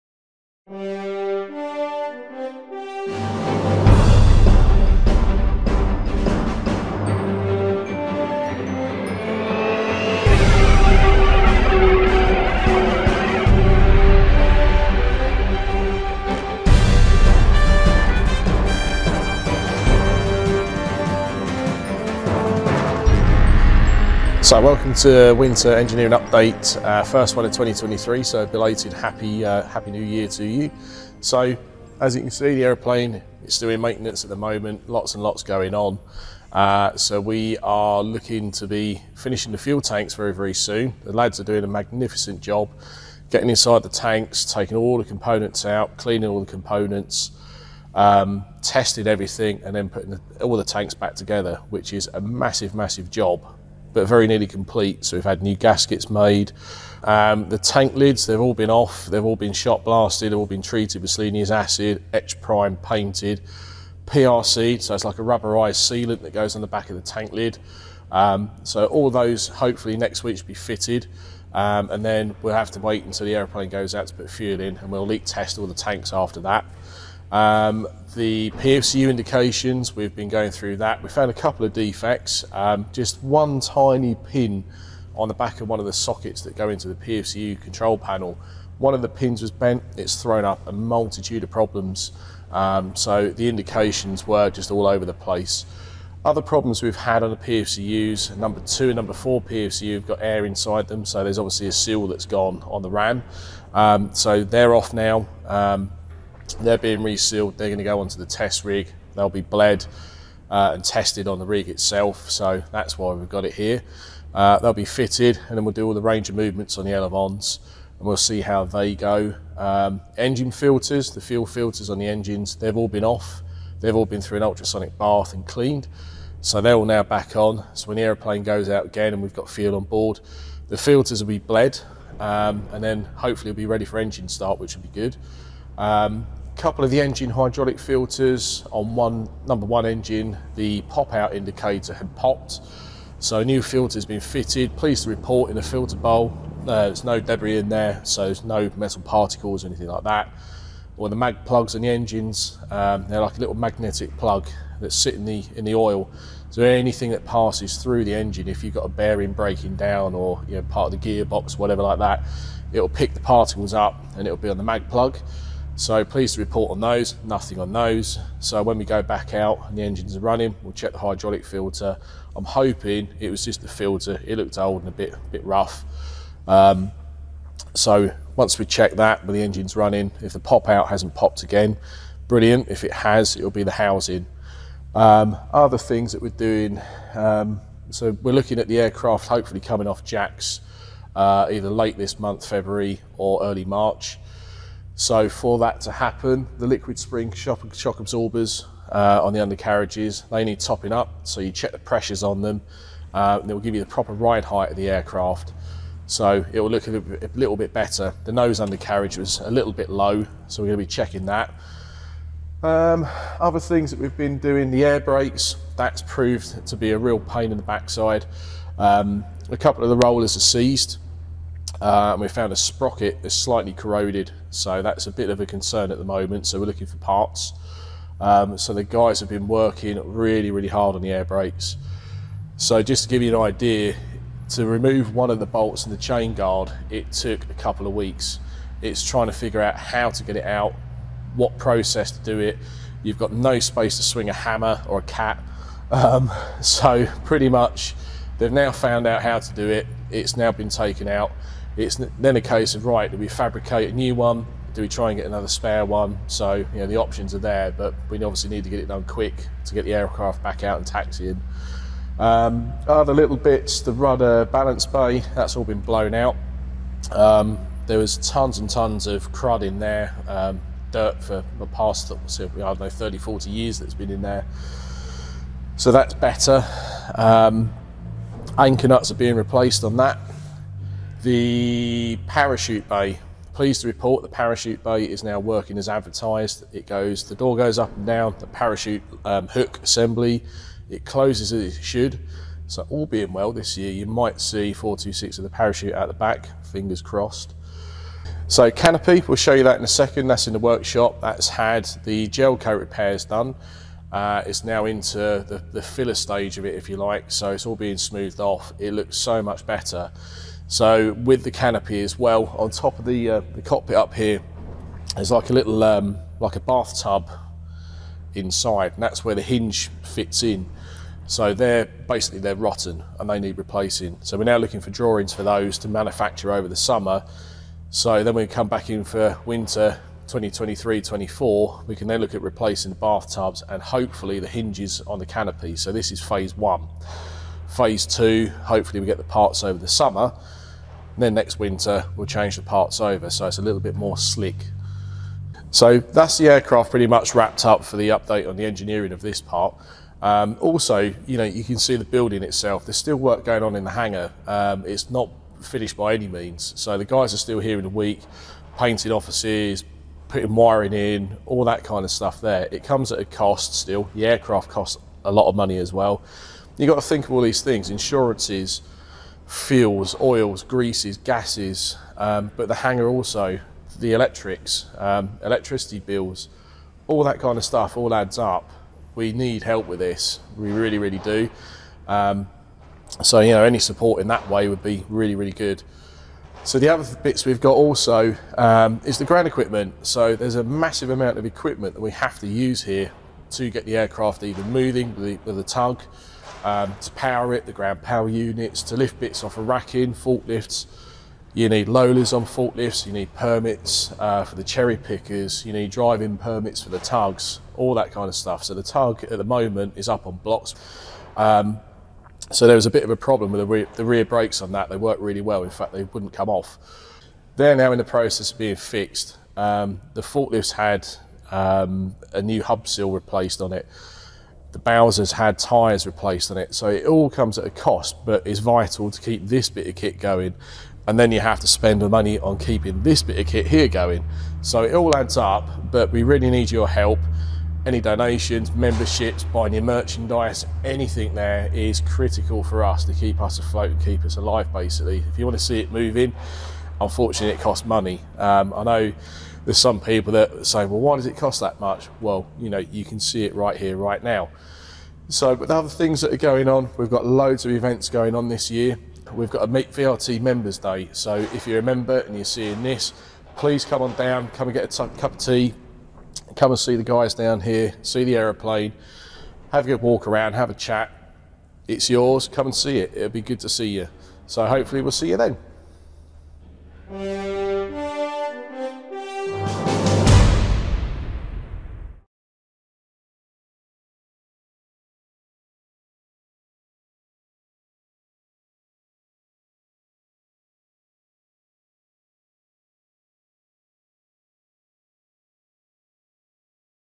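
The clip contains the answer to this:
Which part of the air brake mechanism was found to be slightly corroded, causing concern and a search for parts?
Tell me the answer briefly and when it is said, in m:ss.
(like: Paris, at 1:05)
a sprocket, at 3:42.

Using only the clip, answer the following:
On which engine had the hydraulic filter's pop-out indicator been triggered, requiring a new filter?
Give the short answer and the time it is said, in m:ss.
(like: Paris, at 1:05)
number 1, at 2:19.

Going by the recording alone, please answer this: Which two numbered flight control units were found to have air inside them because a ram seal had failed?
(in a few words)
2 and 4.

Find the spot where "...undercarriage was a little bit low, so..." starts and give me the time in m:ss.
3:28.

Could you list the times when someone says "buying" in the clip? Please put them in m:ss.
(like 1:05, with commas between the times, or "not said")
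7:19.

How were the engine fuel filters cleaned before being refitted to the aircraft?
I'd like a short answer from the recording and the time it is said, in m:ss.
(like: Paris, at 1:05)
ultrasonic bath, at 2:04.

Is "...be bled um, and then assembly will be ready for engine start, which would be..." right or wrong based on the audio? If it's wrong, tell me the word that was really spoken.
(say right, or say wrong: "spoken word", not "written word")
wrong: "hopefully", not "assembly".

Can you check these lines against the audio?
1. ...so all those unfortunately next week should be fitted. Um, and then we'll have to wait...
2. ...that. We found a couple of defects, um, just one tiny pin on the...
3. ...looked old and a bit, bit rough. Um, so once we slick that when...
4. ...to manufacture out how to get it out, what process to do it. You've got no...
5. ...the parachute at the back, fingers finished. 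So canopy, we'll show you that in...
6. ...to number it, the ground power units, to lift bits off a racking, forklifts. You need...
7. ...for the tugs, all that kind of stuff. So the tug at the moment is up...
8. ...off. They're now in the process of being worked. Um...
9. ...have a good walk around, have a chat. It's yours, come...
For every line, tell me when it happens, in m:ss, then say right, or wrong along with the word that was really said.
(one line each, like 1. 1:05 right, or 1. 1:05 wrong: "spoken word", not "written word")
1. 1:08 wrong: "hopefully", not "unfortunately"
2. 1:20 right
3. 2:54 wrong: "check", not "slick"
4. 3:59 wrong: "figure", not "manufacture"
5. 4:55 wrong: "crossed", not "finished"
6. 6:37 wrong: "power", not "number"
7. 6:46 right
8. 6:56 wrong: "fixed", not "worked"
9. 7:49 right.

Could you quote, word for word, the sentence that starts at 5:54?
Um, it's not finished by any means.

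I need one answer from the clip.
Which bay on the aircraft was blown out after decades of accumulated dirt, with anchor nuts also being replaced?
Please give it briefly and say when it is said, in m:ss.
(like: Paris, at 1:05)
rudder balance bay, at 4:23.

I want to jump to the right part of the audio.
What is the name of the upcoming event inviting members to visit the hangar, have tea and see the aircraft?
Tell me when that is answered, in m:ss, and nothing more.
7:39.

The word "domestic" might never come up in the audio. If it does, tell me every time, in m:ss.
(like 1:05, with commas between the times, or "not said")
not said.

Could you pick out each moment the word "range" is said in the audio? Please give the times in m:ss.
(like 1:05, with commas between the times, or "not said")
1:56.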